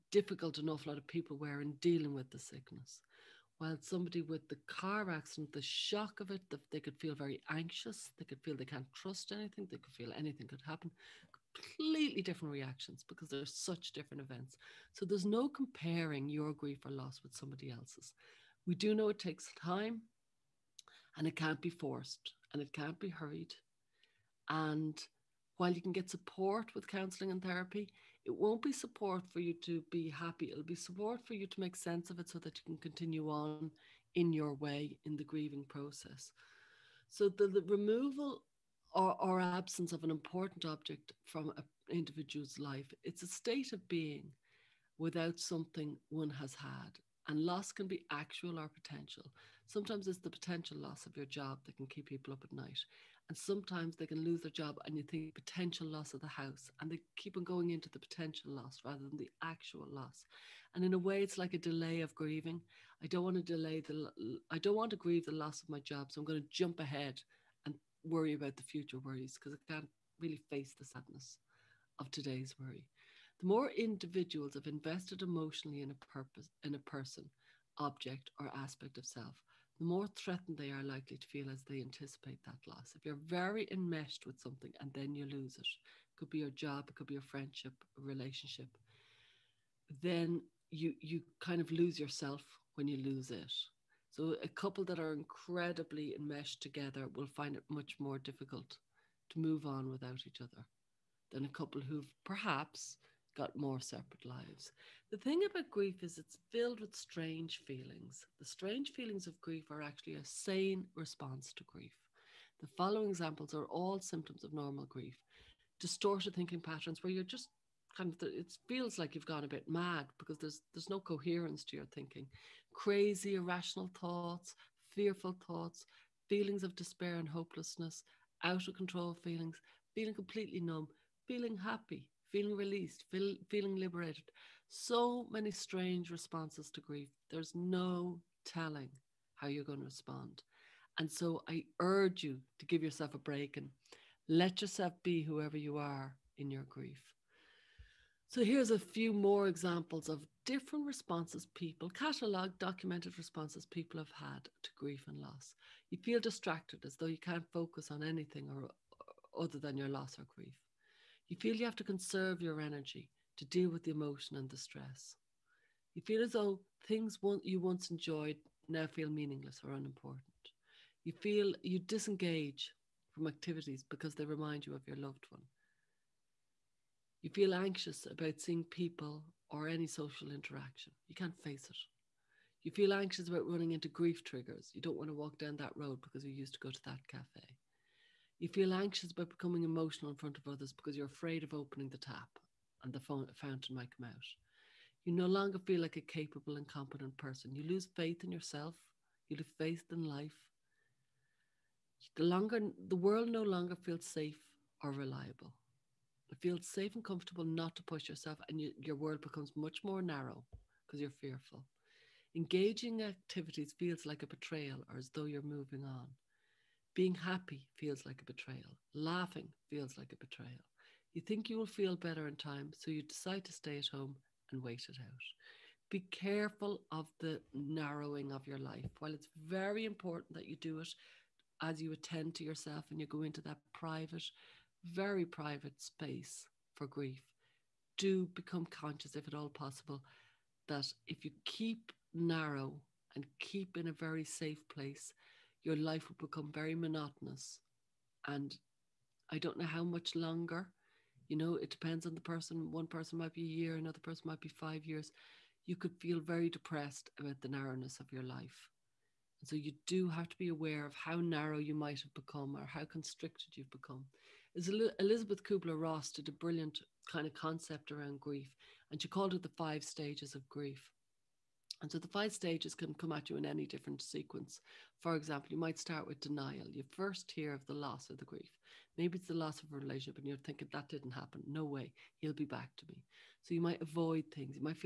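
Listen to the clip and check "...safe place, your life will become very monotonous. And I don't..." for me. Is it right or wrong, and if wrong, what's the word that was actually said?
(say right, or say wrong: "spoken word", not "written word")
right.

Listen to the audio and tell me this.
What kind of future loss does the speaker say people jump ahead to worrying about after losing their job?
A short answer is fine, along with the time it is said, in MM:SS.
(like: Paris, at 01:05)
the house, at 00:56.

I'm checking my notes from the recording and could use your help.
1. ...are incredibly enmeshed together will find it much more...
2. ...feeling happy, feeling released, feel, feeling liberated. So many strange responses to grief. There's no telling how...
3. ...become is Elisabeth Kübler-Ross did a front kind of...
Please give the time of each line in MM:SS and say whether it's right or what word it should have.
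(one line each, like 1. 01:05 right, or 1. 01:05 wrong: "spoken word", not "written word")
1. 01:34 right
2. 02:11 right
3. 04:23 wrong: "brilliant", not "front".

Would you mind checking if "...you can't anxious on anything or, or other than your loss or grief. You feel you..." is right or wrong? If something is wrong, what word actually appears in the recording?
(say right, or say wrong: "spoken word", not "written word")
wrong: "focus", not "anxious".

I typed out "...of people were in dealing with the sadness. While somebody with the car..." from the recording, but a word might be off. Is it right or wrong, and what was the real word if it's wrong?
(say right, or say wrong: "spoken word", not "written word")
wrong: "sickness", not "sadness".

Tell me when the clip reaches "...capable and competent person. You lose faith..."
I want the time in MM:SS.
03:16.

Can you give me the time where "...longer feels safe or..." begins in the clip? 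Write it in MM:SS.
03:23.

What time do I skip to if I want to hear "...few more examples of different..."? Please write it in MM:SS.
02:28.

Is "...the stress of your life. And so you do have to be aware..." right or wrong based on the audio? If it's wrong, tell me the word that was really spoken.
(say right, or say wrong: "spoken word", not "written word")
wrong: "narrowness", not "stress".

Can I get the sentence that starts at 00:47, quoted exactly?
And loss can be actual or potential.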